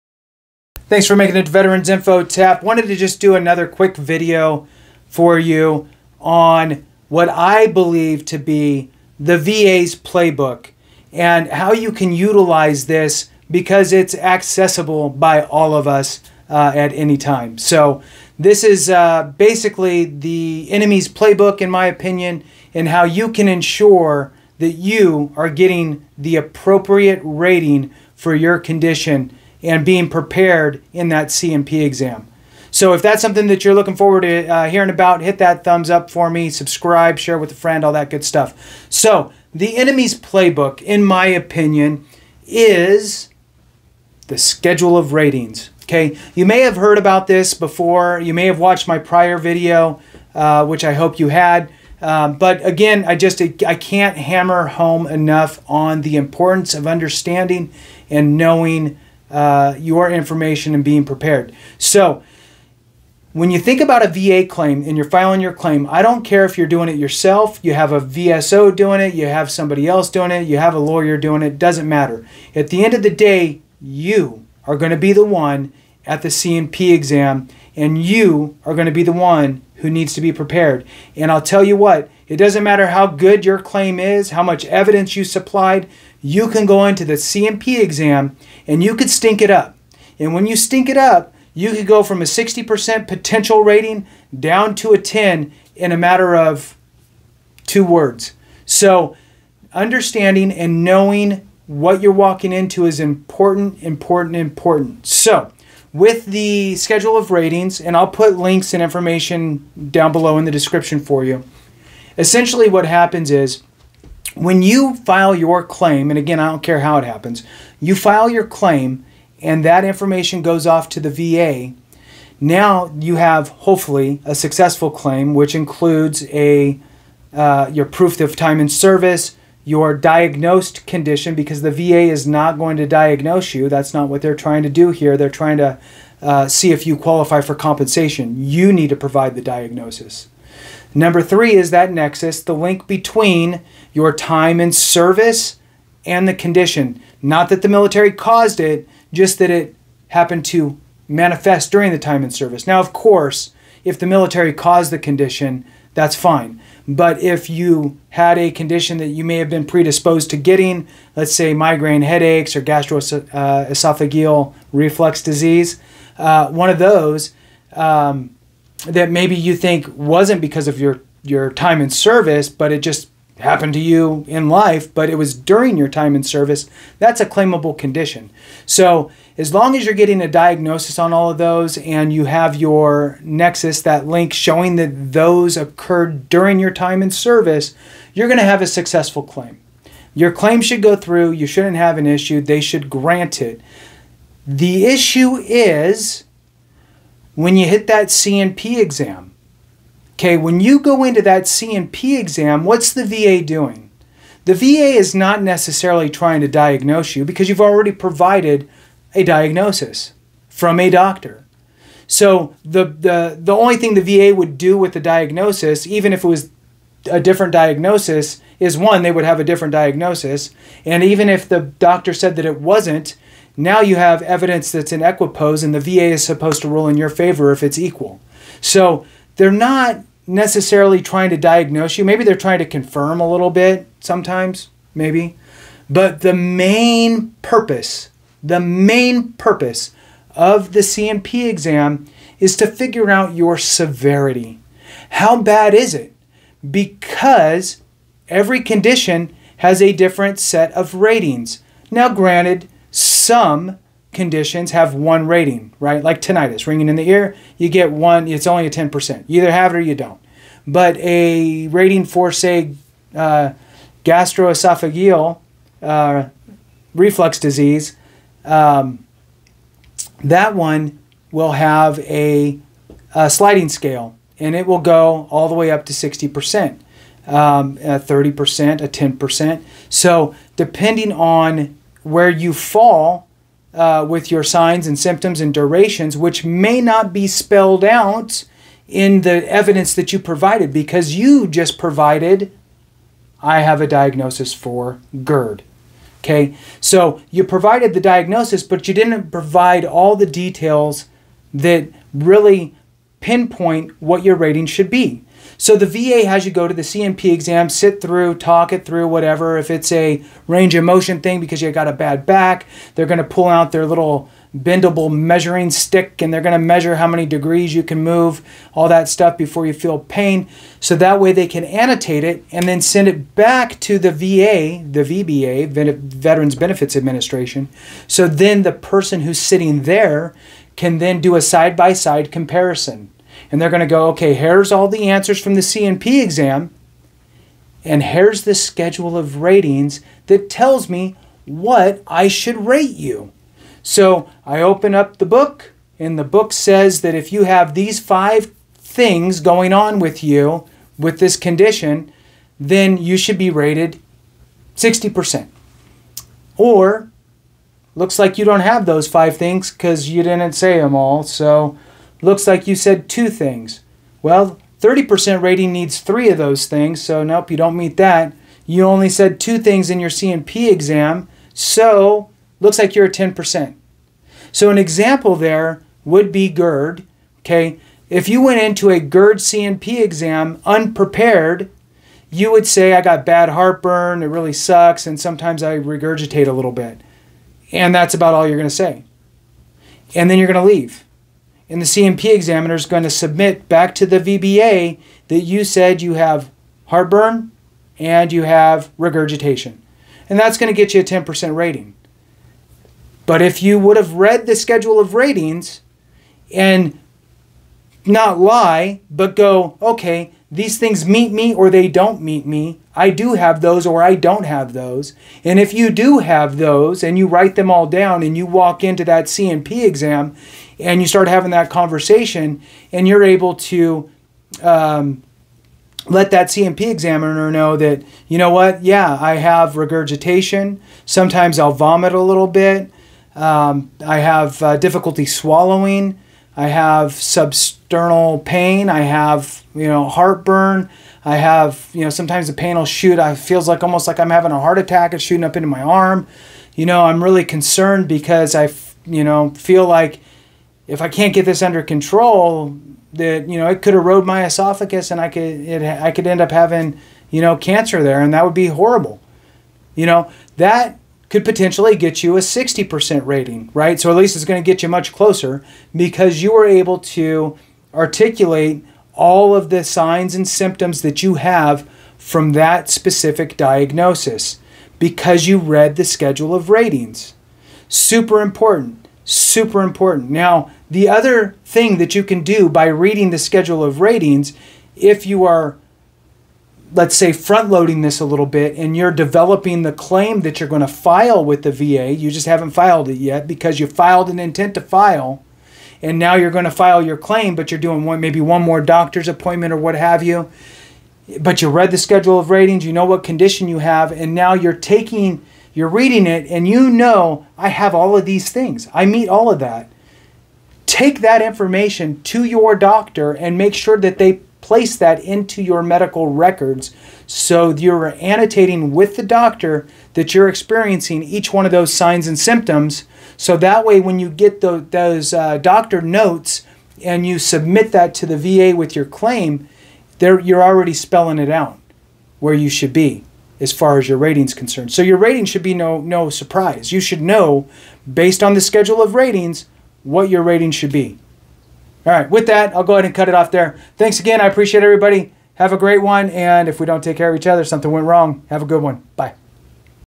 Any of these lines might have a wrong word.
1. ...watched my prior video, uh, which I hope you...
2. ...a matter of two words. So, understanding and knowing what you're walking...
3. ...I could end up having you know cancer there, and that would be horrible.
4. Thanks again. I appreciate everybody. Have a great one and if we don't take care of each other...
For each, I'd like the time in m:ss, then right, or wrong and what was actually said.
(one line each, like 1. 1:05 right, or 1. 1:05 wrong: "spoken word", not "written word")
1. 0:48 right
2. 1:35 right
3. 7:35 right
4. 9:03 right.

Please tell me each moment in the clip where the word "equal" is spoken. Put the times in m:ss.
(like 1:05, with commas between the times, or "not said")
3:47.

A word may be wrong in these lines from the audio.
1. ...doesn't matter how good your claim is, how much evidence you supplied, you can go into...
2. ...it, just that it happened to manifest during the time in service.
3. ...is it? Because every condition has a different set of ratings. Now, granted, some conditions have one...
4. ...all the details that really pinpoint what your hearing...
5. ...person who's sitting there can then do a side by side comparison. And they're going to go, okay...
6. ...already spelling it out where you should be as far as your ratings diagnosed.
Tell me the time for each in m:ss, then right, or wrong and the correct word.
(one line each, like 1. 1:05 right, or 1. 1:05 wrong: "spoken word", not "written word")
1. 1:22 right
2. 2:28 right
3. 4:05 right
4. 4:59 wrong: "rating", not "hearing"
5. 5:28 right
6. 8:50 wrong: "concerned", not "diagnosed".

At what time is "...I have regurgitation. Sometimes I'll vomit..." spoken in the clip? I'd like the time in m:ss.
7:09.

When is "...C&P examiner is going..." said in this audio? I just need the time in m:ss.
6:31.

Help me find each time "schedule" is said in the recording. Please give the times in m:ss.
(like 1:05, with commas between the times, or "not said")
0:44, 1:46, 5:38, 6:44, 7:56, 8:03, 8:21, 8:58.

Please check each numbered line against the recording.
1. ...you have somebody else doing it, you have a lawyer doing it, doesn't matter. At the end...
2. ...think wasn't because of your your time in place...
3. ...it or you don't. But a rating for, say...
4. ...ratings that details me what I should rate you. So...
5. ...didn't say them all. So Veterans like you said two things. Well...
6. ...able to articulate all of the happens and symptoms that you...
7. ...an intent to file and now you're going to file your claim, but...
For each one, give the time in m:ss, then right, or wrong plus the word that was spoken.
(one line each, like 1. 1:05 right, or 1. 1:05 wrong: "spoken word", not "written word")
1. 1:09 right
2. 2:49 wrong: "service", not "place"
3. 4:19 right
4. 5:39 wrong: "tells", not "details"
5. 6:00 wrong: "Looks", not "Veterans"
6. 7:46 wrong: "signs", not "happens"
7. 8:14 right.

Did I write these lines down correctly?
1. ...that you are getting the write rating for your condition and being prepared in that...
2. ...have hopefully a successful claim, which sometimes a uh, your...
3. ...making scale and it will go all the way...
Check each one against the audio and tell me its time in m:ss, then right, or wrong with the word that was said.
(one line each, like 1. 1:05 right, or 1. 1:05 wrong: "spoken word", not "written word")
1. 0:24 wrong: "appropriate", not "write"
2. 2:03 wrong: "includes", not "sometimes"
3. 4:33 wrong: "sliding", not "making".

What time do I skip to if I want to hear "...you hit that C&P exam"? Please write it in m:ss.
3:17.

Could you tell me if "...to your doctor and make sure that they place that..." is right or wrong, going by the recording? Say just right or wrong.
right.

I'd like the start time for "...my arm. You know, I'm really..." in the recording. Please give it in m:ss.
7:25.